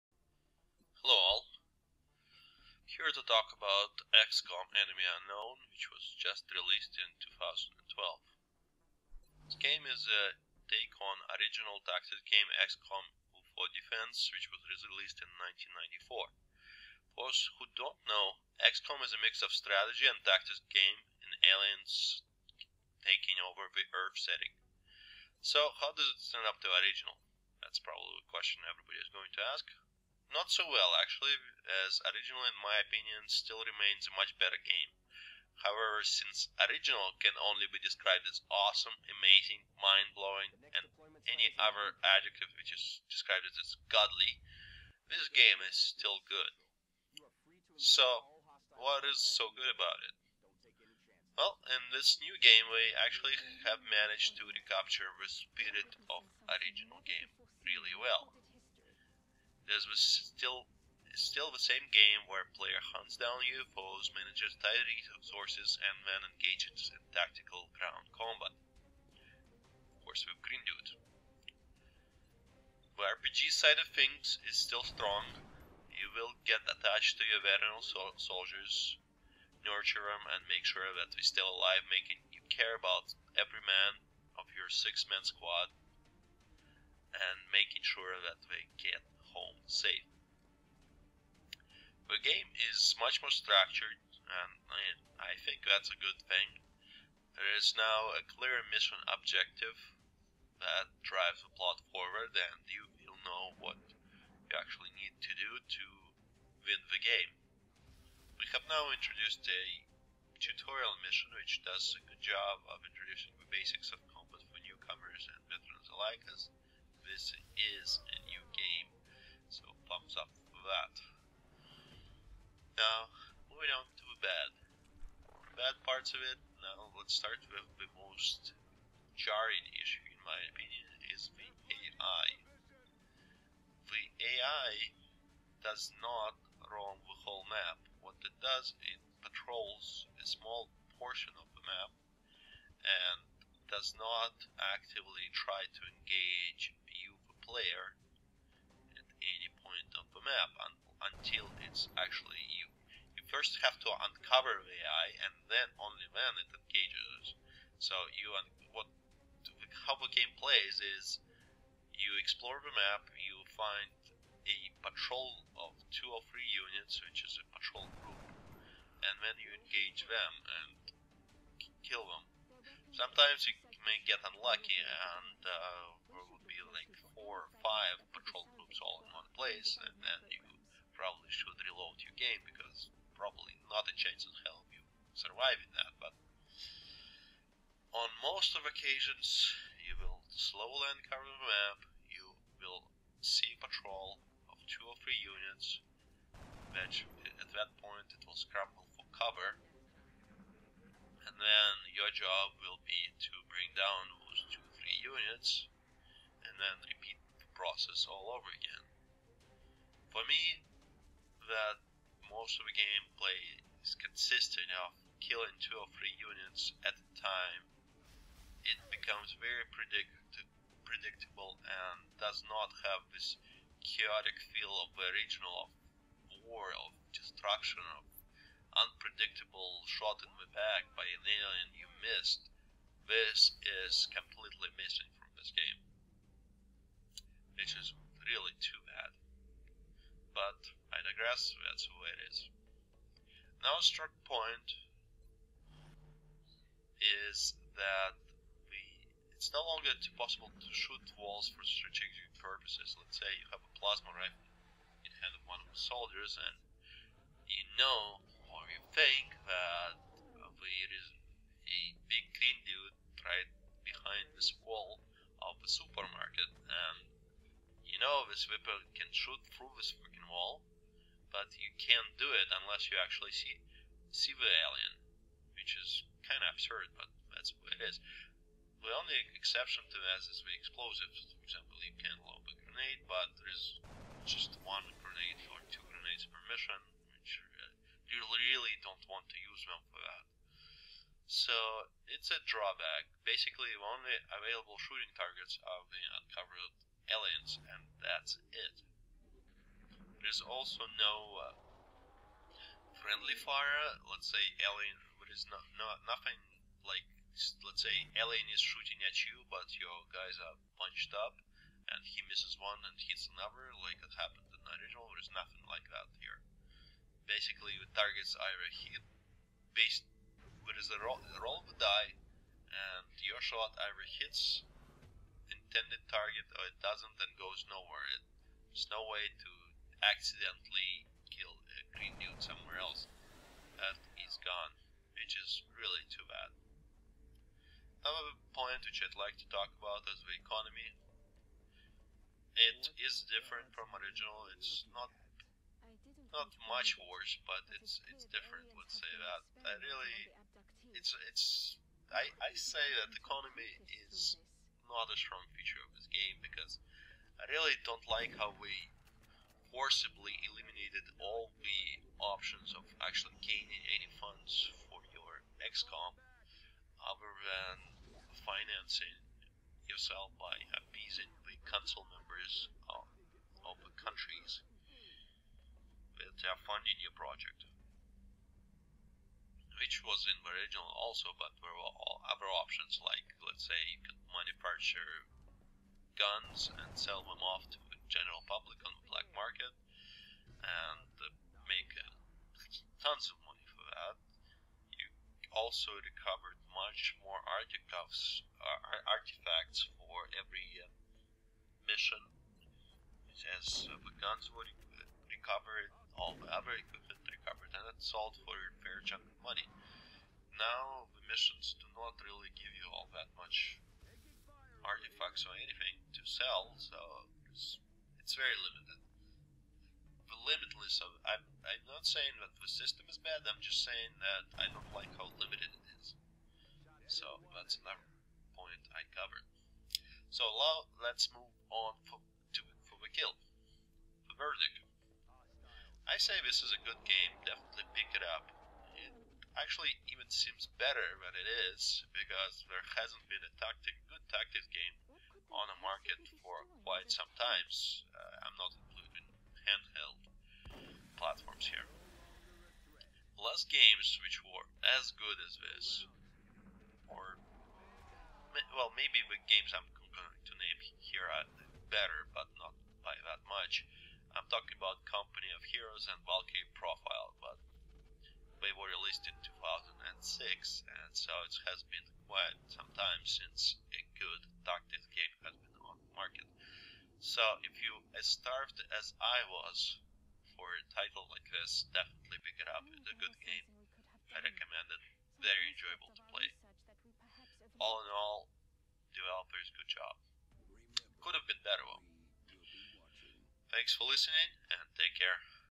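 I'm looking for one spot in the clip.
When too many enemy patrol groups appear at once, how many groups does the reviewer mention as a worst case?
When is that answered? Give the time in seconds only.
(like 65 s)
177 s.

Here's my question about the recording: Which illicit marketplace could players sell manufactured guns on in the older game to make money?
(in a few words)
black market.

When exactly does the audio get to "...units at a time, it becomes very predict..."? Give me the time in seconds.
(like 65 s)
216 s.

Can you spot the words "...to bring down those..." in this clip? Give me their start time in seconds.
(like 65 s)
203 s.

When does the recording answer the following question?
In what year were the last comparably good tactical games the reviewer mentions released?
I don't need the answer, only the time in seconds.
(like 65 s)
469 s.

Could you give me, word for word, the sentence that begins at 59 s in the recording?
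This was still still the same game where player hunts down UFOs, manages tight resources, and then engages in tactical ground combat.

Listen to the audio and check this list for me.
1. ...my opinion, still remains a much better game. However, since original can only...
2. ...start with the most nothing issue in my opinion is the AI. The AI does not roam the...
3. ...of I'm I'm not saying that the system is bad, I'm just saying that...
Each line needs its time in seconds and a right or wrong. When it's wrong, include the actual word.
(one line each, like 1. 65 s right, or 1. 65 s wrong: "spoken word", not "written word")
1. 32 s right
2. 127 s wrong: "jarring", not "nothing"
3. 421 s right.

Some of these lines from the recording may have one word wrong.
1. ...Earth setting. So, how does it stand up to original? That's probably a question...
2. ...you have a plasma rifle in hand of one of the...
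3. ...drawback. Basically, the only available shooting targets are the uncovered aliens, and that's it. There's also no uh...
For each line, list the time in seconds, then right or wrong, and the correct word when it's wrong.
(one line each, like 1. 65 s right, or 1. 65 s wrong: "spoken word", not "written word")
1. 23 s right
2. 253 s right
3. 292 s right.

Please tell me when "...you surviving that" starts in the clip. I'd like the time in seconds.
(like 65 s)
184 s.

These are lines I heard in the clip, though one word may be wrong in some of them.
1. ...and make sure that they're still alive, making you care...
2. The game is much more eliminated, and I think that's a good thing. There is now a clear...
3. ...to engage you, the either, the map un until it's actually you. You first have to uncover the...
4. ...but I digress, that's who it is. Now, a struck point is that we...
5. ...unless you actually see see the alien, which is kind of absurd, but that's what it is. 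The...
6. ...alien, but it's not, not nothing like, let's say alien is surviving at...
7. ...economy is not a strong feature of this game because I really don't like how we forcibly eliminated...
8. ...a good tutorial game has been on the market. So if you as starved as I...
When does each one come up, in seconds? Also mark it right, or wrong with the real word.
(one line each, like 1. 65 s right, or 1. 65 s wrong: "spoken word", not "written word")
1. 80 s right
2. 92 s wrong: "structured", not "eliminated"
3. 145 s wrong: "player", not "either"
4. 240 s right
5. 272 s right
6. 304 s wrong: "shooting", not "surviving"
7. 353 s right
8. 473 s wrong: "tactical", not "tutorial".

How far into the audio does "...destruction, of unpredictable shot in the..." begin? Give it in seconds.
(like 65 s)
227 s.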